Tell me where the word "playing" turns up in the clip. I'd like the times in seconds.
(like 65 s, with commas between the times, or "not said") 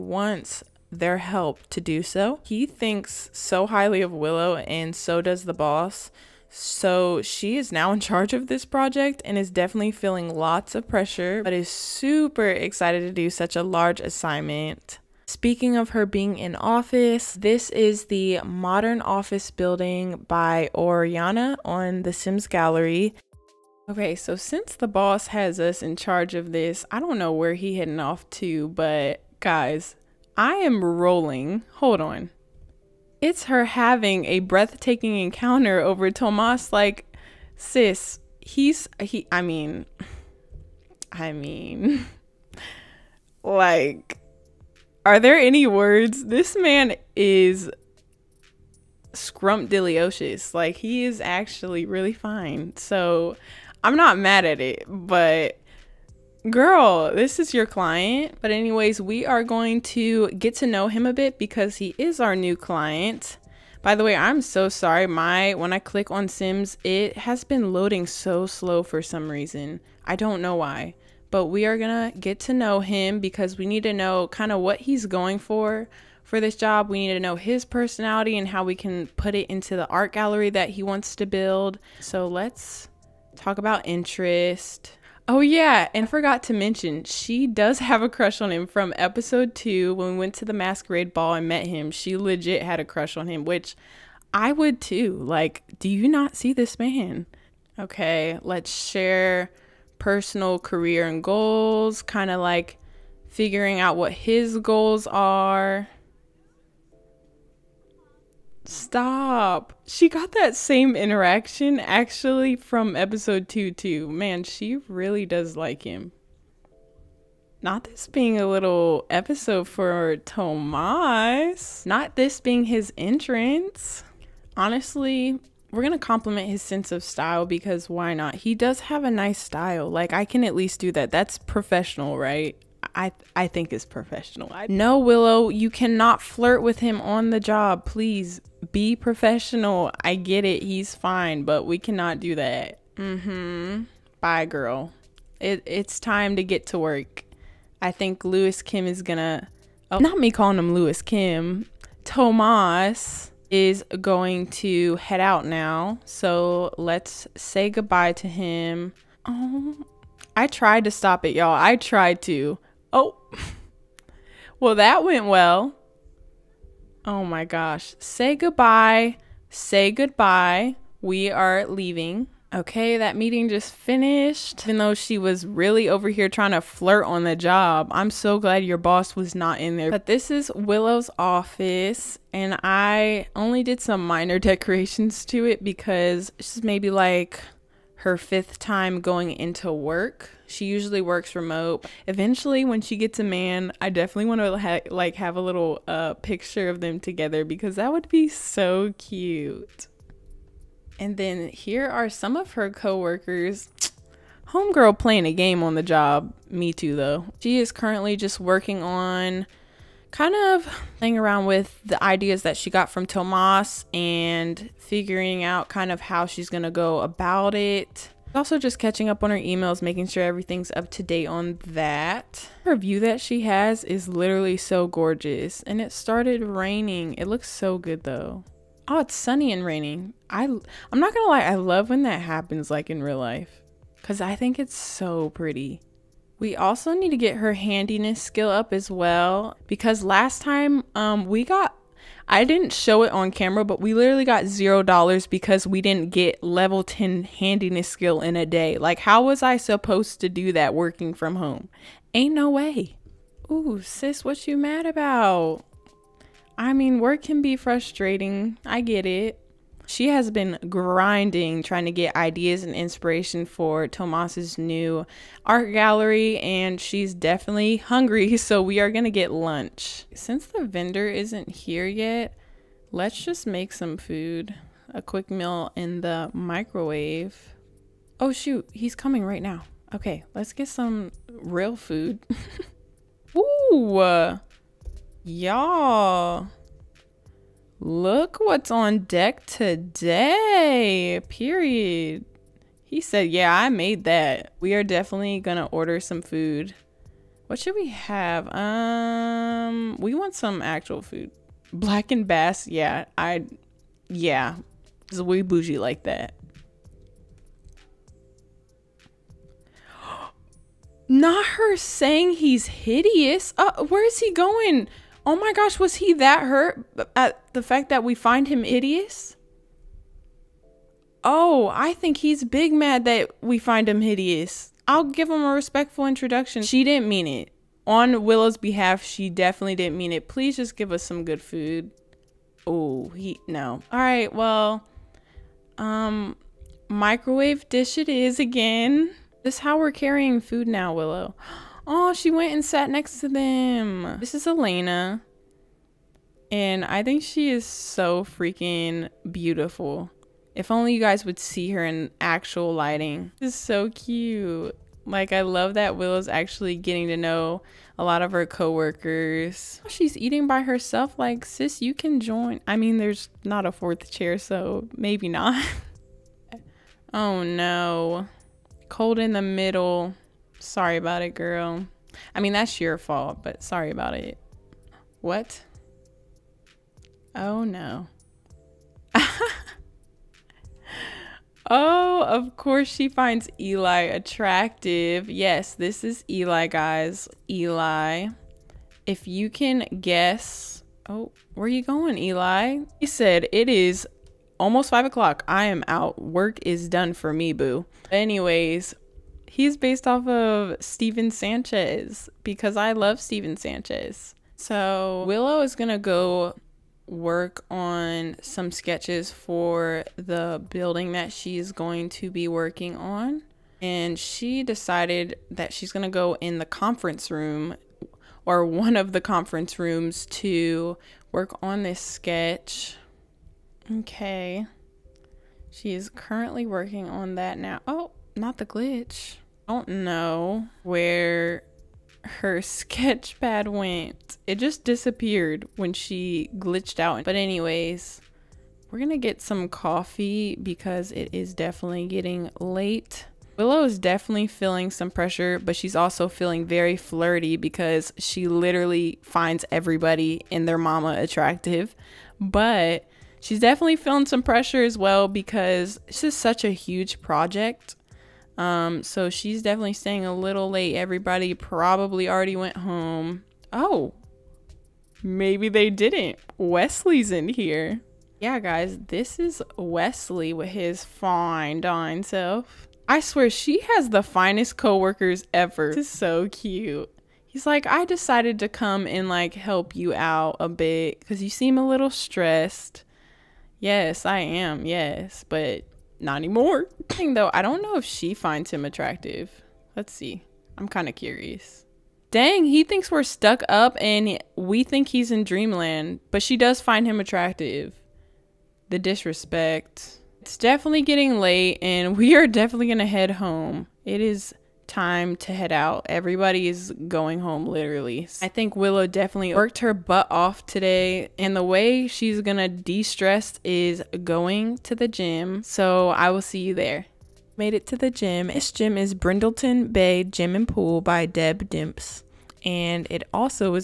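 204 s, 210 s.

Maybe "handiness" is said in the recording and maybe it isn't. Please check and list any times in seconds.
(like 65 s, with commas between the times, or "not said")
237 s, 247 s.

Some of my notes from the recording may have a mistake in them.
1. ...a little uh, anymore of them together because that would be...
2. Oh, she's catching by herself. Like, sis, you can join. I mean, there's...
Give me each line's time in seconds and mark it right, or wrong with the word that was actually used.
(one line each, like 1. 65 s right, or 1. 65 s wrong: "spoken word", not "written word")
1. 195 s wrong: "picture", not "anymore"
2. 359 s wrong: "eating", not "catching".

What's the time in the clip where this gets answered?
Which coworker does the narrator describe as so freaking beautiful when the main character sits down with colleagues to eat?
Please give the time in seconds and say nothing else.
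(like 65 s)
344 s.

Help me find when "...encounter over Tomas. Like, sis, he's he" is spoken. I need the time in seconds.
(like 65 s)
35 s.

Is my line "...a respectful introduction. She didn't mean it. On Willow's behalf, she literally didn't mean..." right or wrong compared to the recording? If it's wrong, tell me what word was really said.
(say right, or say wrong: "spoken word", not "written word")
wrong: "definitely", not "literally".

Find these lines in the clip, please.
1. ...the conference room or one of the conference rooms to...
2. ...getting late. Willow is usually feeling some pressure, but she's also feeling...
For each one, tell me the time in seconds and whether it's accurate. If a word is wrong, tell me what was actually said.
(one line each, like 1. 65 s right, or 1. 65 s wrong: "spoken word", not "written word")
1. 416 s right
2. 442 s wrong: "definitely", not "usually".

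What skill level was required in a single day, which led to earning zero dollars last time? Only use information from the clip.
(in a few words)
10.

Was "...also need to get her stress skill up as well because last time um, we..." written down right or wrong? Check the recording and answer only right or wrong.
wrong.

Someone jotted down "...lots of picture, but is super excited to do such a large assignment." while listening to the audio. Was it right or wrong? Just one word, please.
wrong.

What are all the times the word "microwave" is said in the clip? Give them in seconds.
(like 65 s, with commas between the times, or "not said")
276 s, 336 s.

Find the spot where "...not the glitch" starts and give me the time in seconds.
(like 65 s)
428 s.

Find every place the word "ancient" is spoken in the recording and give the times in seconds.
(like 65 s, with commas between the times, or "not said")
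not said.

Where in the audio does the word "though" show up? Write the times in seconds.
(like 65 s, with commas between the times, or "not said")
174 s, 206 s, 228 s, 487 s.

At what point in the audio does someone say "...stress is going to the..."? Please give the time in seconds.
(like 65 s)
513 s.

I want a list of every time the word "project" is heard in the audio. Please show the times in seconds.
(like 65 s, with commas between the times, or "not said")
8 s, 457 s.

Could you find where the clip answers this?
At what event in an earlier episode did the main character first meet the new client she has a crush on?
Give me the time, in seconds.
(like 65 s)
90 s.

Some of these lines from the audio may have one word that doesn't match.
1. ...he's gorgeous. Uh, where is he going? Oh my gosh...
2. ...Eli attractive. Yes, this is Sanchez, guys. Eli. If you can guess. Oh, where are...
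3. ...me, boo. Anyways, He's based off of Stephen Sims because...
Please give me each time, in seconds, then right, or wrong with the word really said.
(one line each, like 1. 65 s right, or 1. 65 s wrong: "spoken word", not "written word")
1. 312 s wrong: "hideous", not "gorgeous"
2. 383 s wrong: "Eli", not "Sanchez"
3. 397 s wrong: "Sanchez", not "Sims".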